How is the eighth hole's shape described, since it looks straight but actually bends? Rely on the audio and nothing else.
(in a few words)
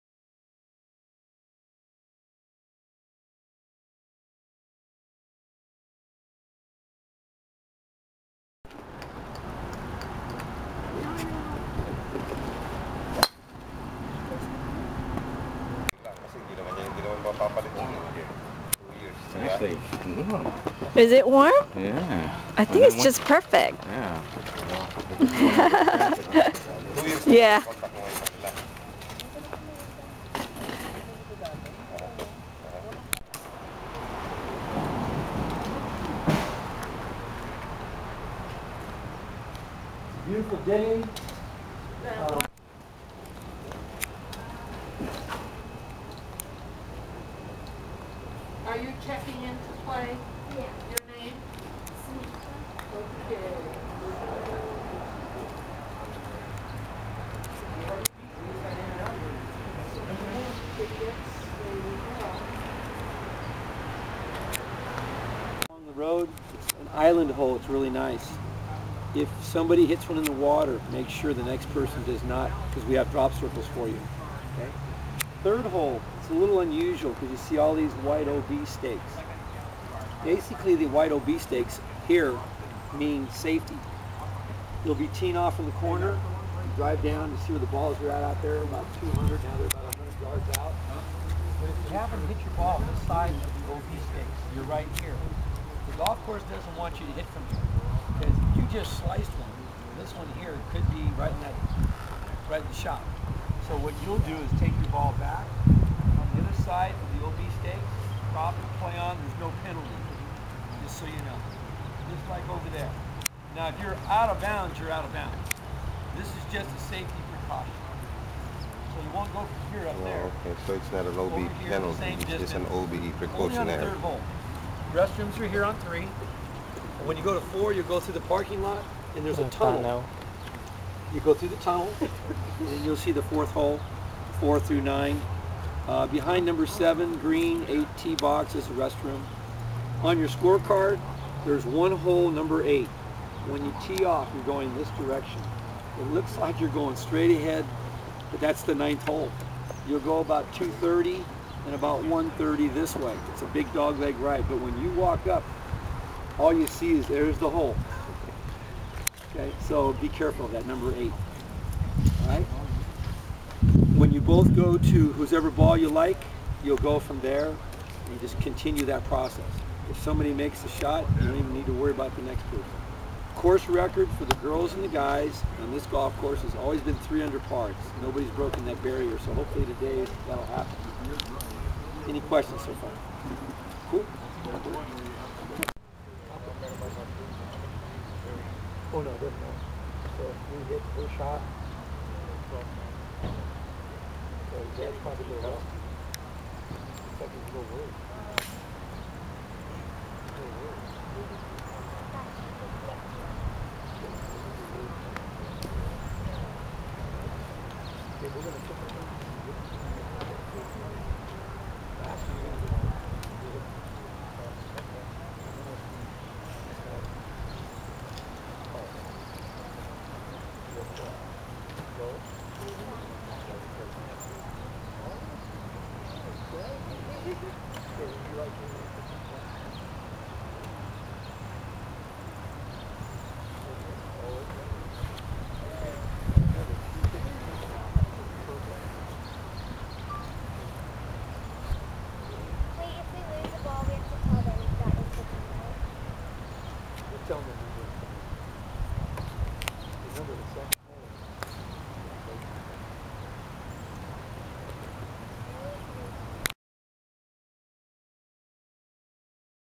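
big dogleg.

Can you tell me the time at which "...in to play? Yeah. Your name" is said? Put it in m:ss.
0:49.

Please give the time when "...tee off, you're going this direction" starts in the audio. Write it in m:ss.
2:23.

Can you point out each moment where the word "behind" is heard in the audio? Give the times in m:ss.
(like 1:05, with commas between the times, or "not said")
2:16.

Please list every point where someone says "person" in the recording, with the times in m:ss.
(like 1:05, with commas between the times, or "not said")
1:11, 2:52.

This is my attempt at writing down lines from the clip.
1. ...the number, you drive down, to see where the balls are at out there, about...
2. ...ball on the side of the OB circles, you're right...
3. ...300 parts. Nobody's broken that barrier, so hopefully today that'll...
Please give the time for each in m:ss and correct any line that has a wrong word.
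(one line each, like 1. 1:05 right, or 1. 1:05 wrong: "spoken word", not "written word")
1. 1:25 wrong: "corner", not "number"
2. 1:32 wrong: "stakes", not "circles"
3. 2:56 right.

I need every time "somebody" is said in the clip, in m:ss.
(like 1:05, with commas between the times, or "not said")
1:09, 2:50.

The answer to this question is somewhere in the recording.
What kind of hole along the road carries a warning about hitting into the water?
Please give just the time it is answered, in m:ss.
1:06.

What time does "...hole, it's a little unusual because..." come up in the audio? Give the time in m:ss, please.
1:15.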